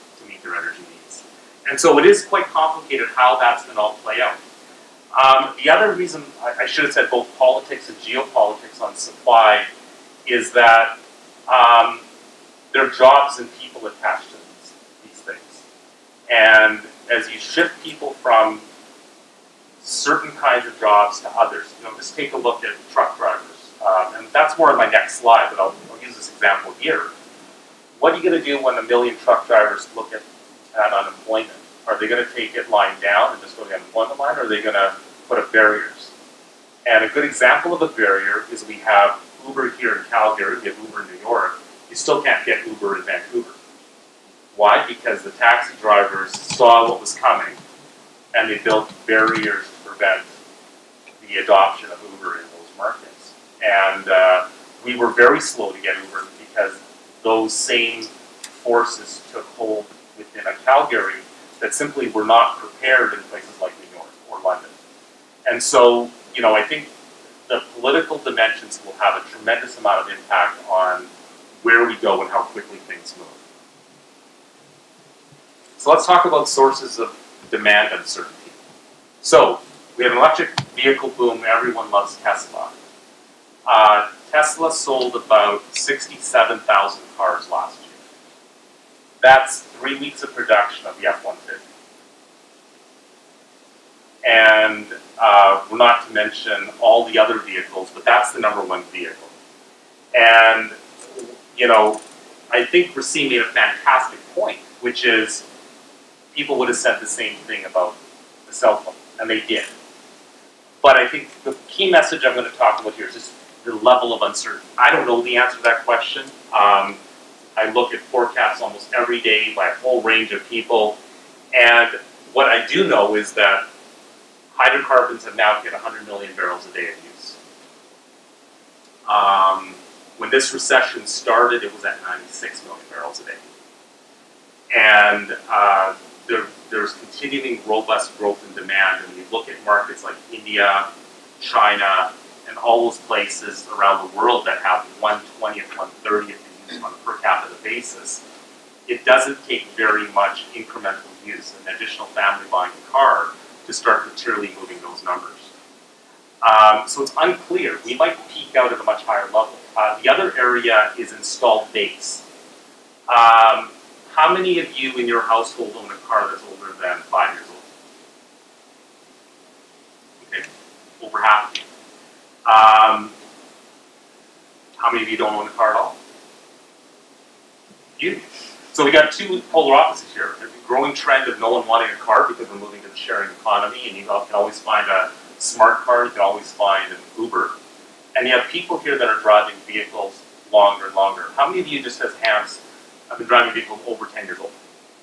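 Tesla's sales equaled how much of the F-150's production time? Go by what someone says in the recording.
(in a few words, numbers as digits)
three weeks.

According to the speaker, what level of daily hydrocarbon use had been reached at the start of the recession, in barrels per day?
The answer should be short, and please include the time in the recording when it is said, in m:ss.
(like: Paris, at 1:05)
96 million, at 2:12.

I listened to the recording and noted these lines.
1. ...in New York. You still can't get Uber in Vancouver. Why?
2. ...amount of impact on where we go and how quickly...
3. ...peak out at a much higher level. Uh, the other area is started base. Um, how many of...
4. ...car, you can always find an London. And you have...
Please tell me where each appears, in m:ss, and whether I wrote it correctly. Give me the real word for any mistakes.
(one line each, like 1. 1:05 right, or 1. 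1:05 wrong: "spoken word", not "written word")
1. 0:41 right
2. 1:09 right
3. 2:38 wrong: "installed", not "started"
4. 3:05 wrong: "Uber", not "London".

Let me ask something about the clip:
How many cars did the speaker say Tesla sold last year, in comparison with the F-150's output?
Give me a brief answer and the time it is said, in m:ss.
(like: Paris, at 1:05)
67,000, at 1:25.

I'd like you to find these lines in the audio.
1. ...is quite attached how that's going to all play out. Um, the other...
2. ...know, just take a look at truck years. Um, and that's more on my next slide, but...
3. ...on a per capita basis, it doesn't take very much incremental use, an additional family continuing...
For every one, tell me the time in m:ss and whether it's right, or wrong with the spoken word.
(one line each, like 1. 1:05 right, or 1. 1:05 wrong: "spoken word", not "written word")
1. 0:02 wrong: "complicated", not "attached"
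2. 0:21 wrong: "drivers", not "years"
3. 2:26 wrong: "buying", not "continuing".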